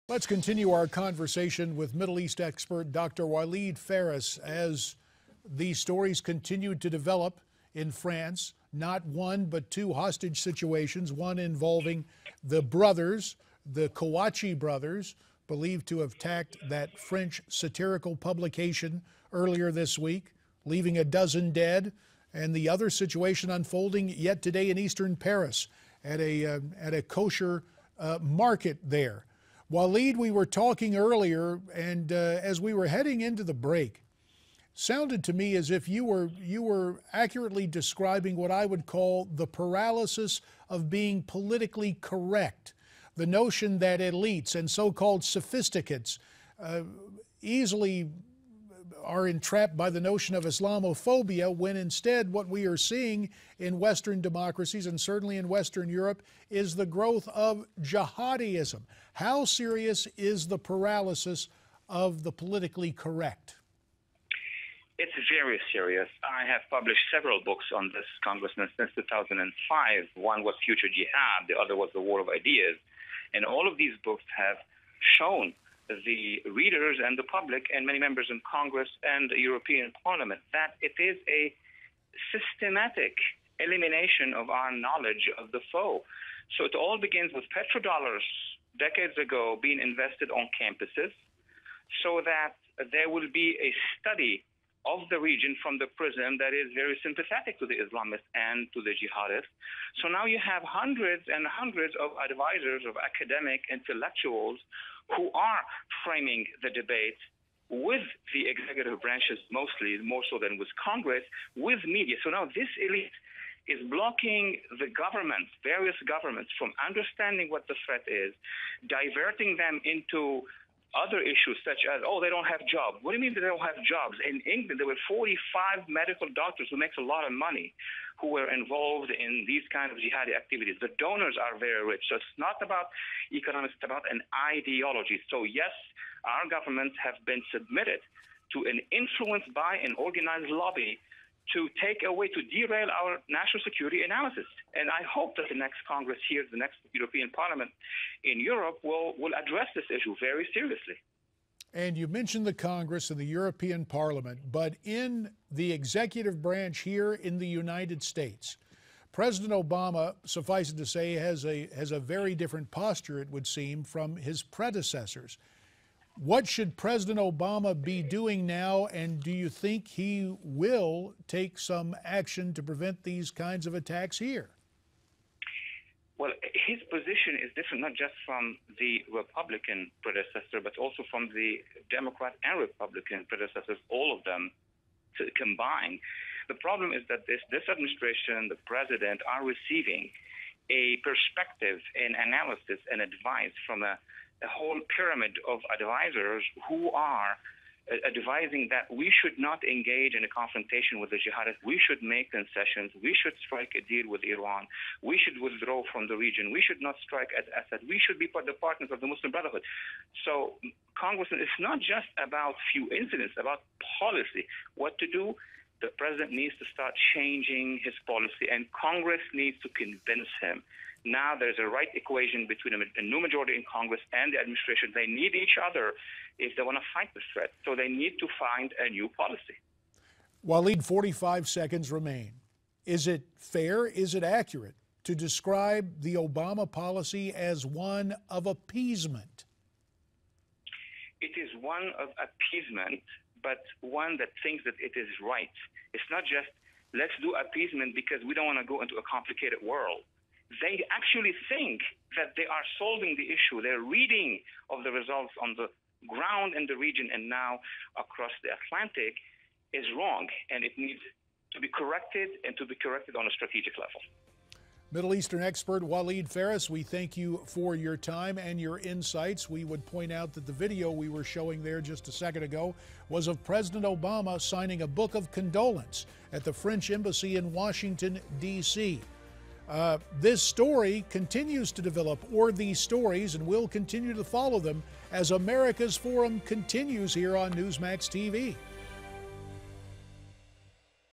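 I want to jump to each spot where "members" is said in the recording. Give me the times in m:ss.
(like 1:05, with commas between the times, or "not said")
1:17.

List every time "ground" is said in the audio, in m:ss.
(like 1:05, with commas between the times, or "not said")
4:16.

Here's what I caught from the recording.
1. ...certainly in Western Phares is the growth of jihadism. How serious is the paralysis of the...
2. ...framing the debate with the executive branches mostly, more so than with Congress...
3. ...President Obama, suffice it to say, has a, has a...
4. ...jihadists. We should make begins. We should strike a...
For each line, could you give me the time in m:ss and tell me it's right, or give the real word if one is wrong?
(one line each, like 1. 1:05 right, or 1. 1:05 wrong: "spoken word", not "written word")
1. 0:54 wrong: "Europe", not "Phares"
2. 1:46 right
3. 2:39 right
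4. 3:21 wrong: "concessions", not "begins".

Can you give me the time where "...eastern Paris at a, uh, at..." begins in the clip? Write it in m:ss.
0:24.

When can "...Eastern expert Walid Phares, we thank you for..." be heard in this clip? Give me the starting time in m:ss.
4:25.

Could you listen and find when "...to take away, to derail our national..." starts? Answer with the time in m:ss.
2:21.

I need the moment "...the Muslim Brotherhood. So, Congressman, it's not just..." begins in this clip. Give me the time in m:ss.
3:29.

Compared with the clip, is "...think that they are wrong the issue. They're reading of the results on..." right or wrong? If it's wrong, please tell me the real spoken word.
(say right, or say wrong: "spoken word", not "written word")
wrong: "solving", not "wrong".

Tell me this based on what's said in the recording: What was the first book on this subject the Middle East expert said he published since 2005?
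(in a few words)
Future Jihad.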